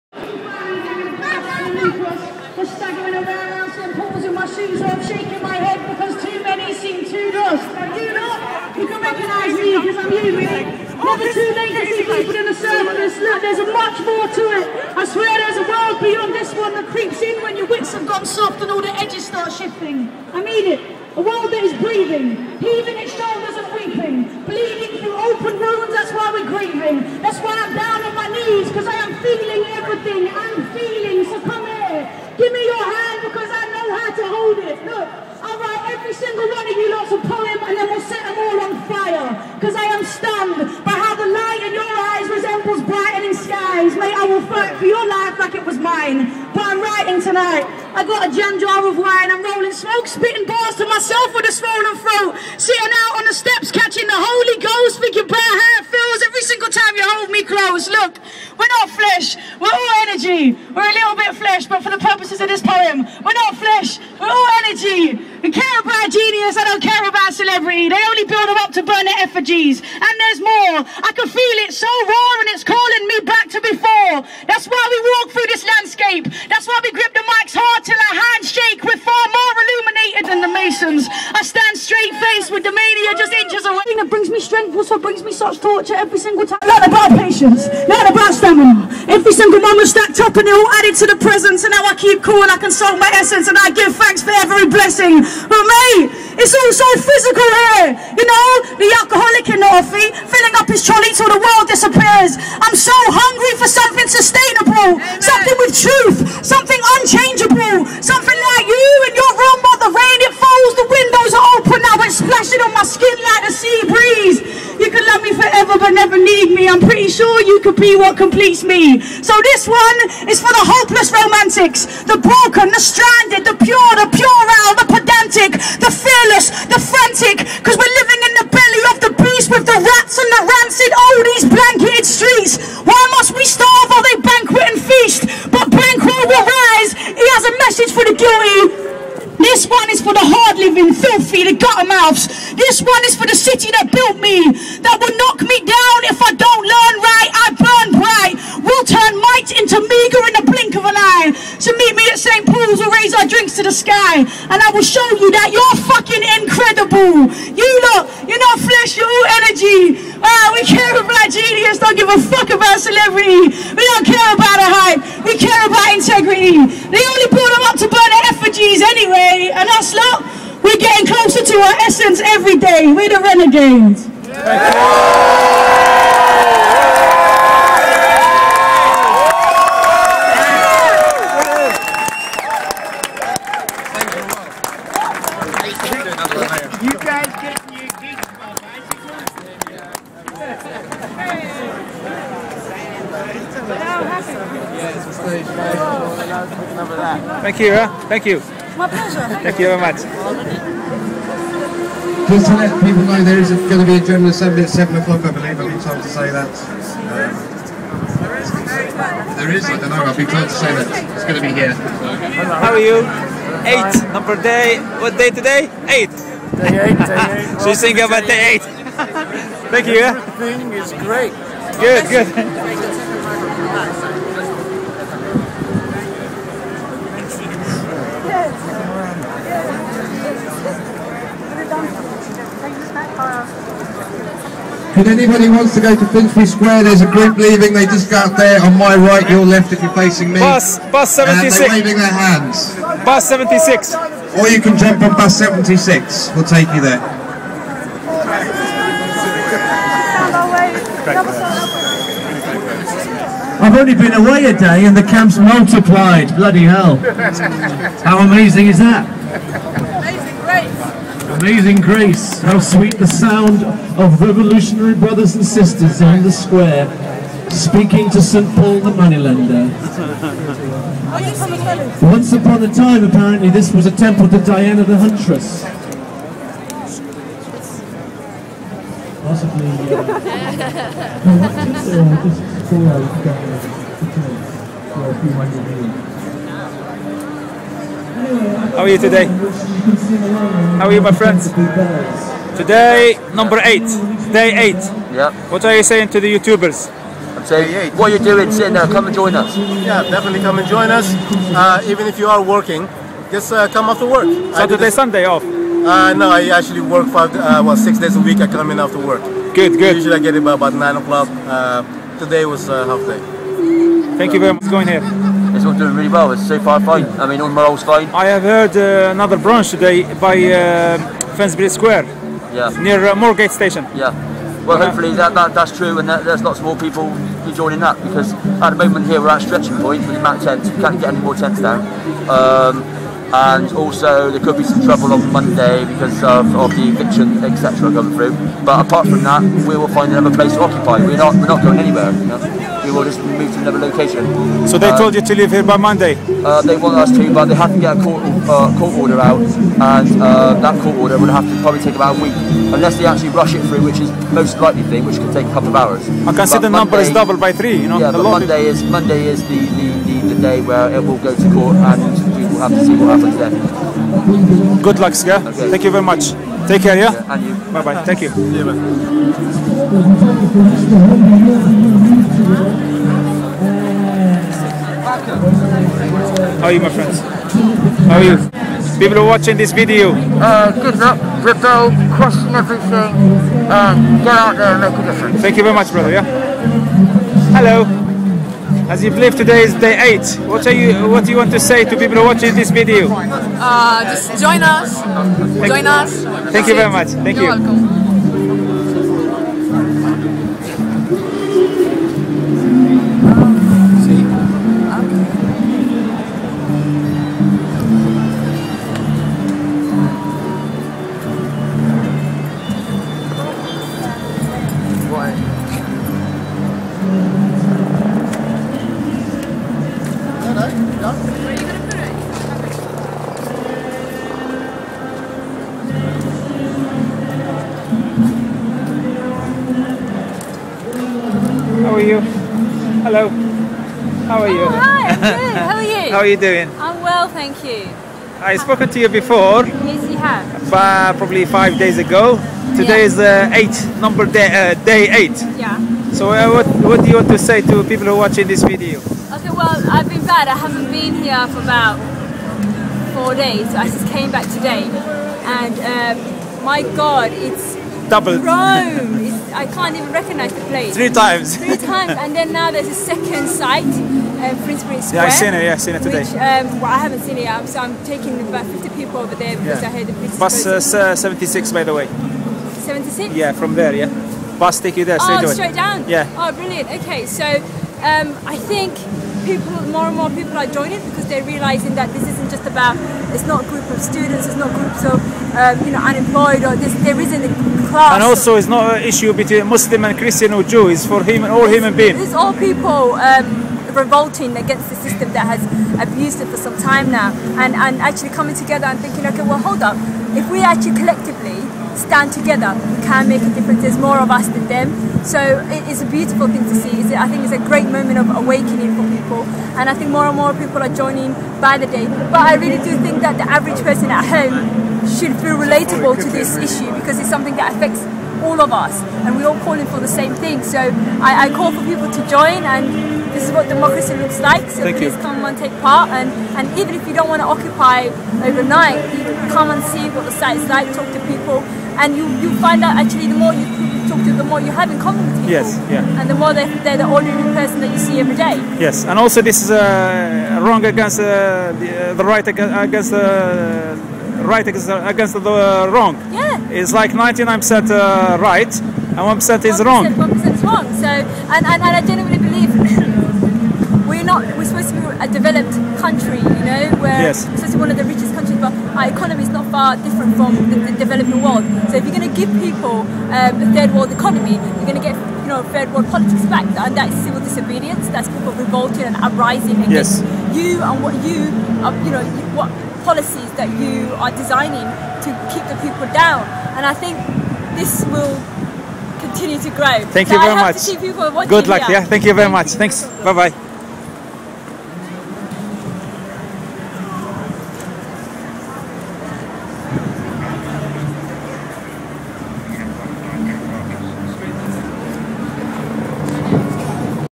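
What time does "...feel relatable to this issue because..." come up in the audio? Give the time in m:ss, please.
8:35.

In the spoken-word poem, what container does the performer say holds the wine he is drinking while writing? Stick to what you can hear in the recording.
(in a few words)
jam jar.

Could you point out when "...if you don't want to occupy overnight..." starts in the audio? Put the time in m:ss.
8:46.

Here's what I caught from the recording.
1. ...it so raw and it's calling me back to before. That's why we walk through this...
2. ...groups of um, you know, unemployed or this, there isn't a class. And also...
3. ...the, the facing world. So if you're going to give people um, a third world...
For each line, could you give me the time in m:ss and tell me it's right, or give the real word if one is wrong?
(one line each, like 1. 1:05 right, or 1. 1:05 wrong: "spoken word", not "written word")
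1. 1:11 right
2. 8:04 right
3. 9:20 wrong: "developing", not "facing".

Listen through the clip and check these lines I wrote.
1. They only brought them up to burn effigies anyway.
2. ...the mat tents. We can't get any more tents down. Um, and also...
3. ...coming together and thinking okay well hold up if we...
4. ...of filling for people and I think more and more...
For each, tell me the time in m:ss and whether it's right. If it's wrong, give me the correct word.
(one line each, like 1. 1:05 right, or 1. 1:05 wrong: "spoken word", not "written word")
1. 2:46 right
2. 5:30 right
3. 8:18 right
4. 8:28 wrong: "awakening", not "filling".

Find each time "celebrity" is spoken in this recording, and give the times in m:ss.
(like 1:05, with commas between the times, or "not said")
1:07, 2:42.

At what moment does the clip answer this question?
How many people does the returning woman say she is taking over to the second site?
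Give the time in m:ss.
7:48.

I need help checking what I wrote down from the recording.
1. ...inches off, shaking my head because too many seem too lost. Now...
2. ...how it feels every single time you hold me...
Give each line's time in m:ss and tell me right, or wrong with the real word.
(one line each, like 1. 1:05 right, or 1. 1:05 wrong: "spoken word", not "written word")
1. 0:04 wrong: "shoes", not "inches"
2. 0:55 right.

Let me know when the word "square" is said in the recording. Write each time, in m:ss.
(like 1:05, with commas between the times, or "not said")
3:56, 4:26, 5:21, 7:45.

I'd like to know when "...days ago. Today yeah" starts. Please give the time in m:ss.
7:21.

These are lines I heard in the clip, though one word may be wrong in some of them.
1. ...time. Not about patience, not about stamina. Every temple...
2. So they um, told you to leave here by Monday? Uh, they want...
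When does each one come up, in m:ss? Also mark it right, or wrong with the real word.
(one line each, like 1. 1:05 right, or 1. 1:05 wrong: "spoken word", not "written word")
1. 1:26 wrong: "single", not "temple"
2. 5:44 right.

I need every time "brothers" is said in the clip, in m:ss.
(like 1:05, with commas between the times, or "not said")
4:24, 6:25.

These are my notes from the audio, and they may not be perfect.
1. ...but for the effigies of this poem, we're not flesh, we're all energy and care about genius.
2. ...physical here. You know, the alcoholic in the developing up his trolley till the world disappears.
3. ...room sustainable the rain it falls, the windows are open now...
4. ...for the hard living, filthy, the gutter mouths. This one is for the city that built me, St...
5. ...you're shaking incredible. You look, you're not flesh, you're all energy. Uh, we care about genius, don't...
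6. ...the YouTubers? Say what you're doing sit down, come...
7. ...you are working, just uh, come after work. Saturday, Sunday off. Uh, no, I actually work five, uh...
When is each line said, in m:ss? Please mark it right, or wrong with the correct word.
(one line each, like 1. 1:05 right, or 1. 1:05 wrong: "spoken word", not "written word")
1. 1:01 wrong: "purposes", not "effigies"
2. 1:36 wrong: "filling", not "developing"
3. 1:49 wrong: "while", not "sustainable"
4. 2:20 right
5. 2:35 wrong: "fucking", not "shaking"
6. 4:56 right
7. 5:02 right.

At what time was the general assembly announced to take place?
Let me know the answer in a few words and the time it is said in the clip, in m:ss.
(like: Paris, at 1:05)
7 o'clock, at 3:24.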